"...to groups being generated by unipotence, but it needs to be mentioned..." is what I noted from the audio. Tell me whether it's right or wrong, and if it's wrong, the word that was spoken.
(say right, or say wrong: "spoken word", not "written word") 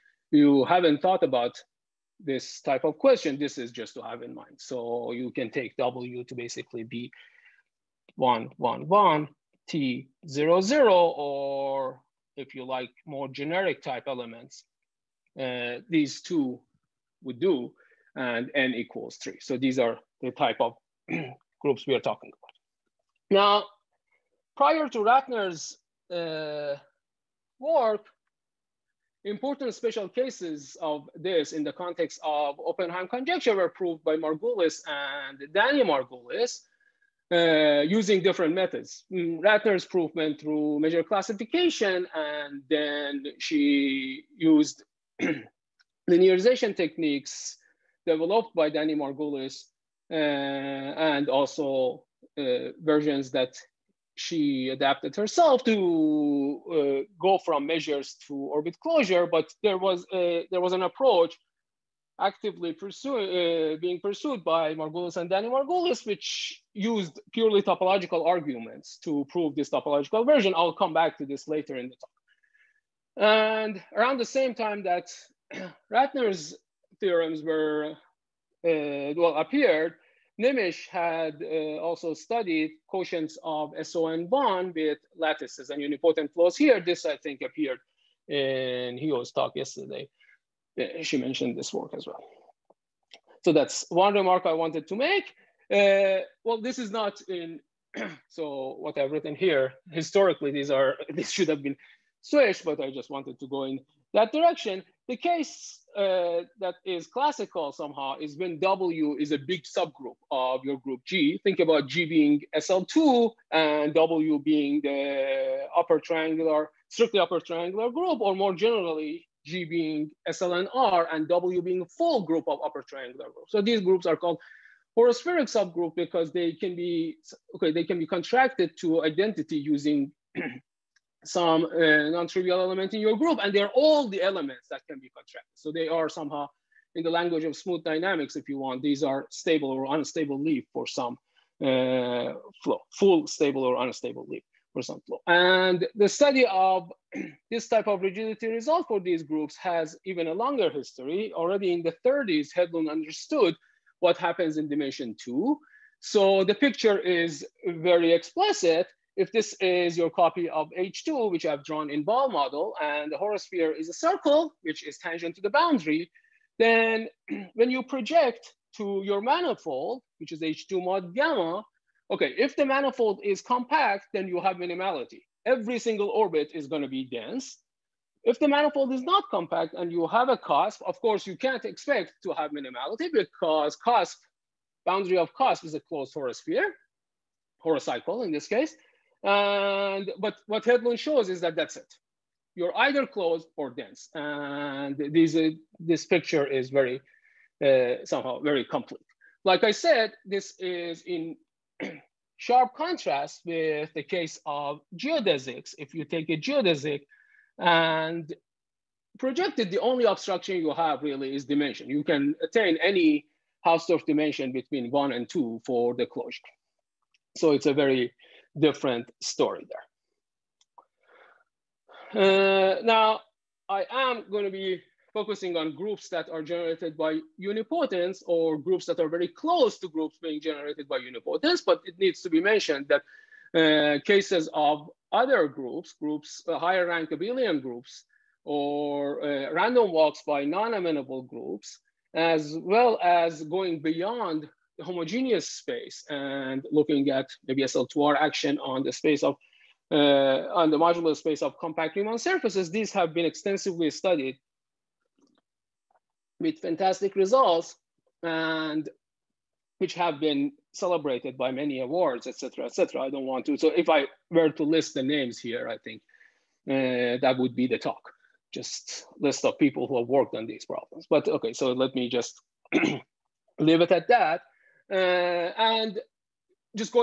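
right.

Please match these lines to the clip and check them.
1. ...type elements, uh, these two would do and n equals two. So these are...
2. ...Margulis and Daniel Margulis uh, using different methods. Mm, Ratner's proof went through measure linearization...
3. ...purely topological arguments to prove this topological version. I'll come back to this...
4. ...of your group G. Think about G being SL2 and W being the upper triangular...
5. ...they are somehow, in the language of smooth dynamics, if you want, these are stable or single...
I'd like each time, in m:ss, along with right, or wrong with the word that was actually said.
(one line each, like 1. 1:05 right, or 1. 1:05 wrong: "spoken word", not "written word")
1. 0:13 wrong: "three", not "two"
2. 0:34 wrong: "classification", not "linearization"
3. 1:07 right
4. 1:50 right
5. 2:15 wrong: "unstable", not "single".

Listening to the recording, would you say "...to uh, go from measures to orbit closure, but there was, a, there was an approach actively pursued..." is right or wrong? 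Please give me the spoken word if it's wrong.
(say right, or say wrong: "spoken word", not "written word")
right.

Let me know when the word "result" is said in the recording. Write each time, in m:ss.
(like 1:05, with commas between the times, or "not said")
2:28, 4:17.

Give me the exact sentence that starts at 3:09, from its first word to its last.
And but what Hedlund shows is that that's it.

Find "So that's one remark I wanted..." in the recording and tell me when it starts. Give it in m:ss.
1:33.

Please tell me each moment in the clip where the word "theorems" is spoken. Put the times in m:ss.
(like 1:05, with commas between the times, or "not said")
1:17.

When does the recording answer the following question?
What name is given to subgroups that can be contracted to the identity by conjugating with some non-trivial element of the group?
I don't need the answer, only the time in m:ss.
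2:04.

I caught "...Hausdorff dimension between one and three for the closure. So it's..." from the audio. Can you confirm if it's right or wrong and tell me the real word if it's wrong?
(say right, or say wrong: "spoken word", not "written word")
wrong: "two", not "three".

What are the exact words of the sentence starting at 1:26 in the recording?
This, I think, appeared in Hugo's talk yesterday.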